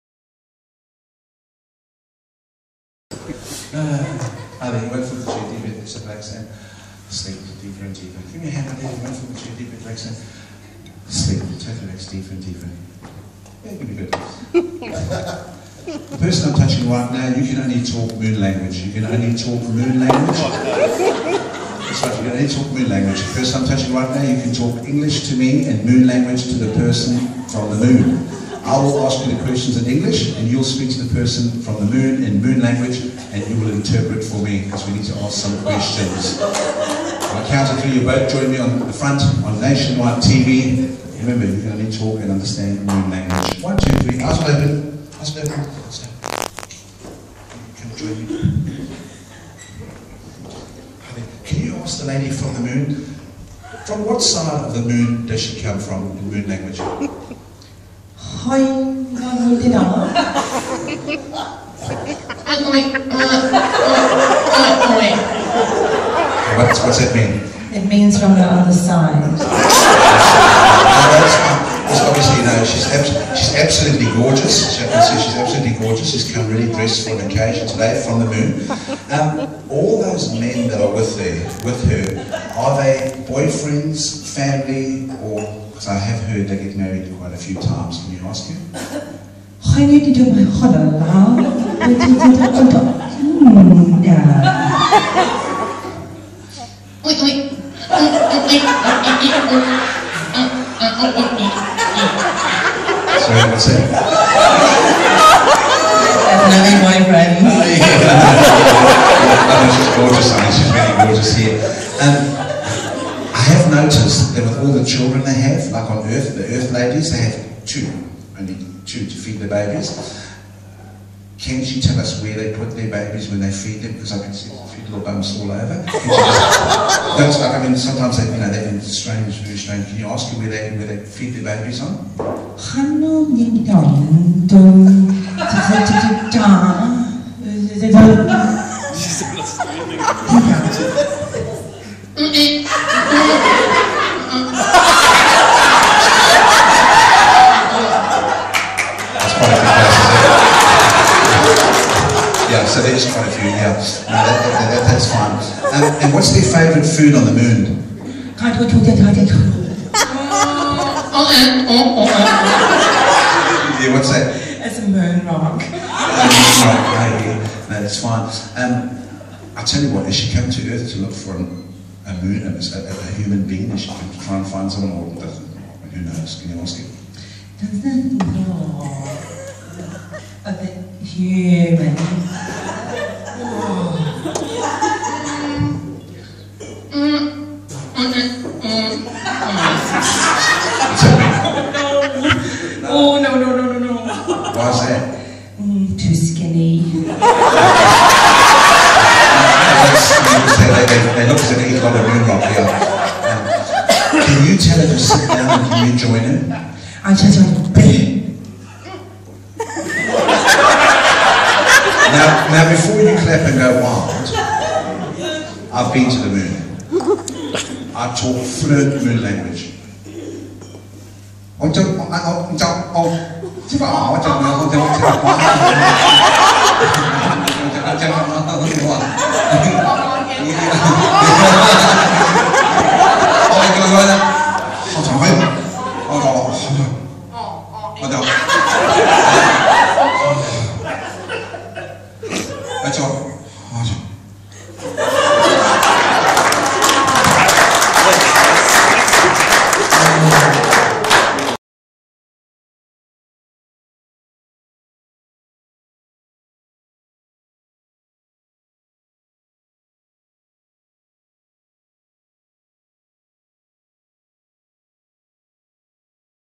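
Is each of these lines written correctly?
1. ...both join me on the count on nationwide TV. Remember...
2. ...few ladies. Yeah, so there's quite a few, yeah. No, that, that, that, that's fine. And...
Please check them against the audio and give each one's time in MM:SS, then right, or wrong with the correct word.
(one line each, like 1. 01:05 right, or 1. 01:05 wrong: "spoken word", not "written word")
1. 00:38 wrong: "front", not "count"
2. 02:29 wrong: "places", not "ladies".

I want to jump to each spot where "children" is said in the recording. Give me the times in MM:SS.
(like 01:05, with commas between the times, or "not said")
01:54.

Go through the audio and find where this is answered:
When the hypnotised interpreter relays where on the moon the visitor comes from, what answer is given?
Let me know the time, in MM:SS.
01:08.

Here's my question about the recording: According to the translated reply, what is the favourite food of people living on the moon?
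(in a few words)
moon rock.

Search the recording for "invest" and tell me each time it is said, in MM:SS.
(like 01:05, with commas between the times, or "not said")
not said.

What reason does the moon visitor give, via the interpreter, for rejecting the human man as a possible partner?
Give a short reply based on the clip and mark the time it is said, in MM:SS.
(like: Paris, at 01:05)
too skinny, at 03:15.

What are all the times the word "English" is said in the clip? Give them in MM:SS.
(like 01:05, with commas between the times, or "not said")
00:24, 00:29.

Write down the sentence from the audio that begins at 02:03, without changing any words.
Because I can see little bumps all over.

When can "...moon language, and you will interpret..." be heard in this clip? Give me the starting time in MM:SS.
00:32.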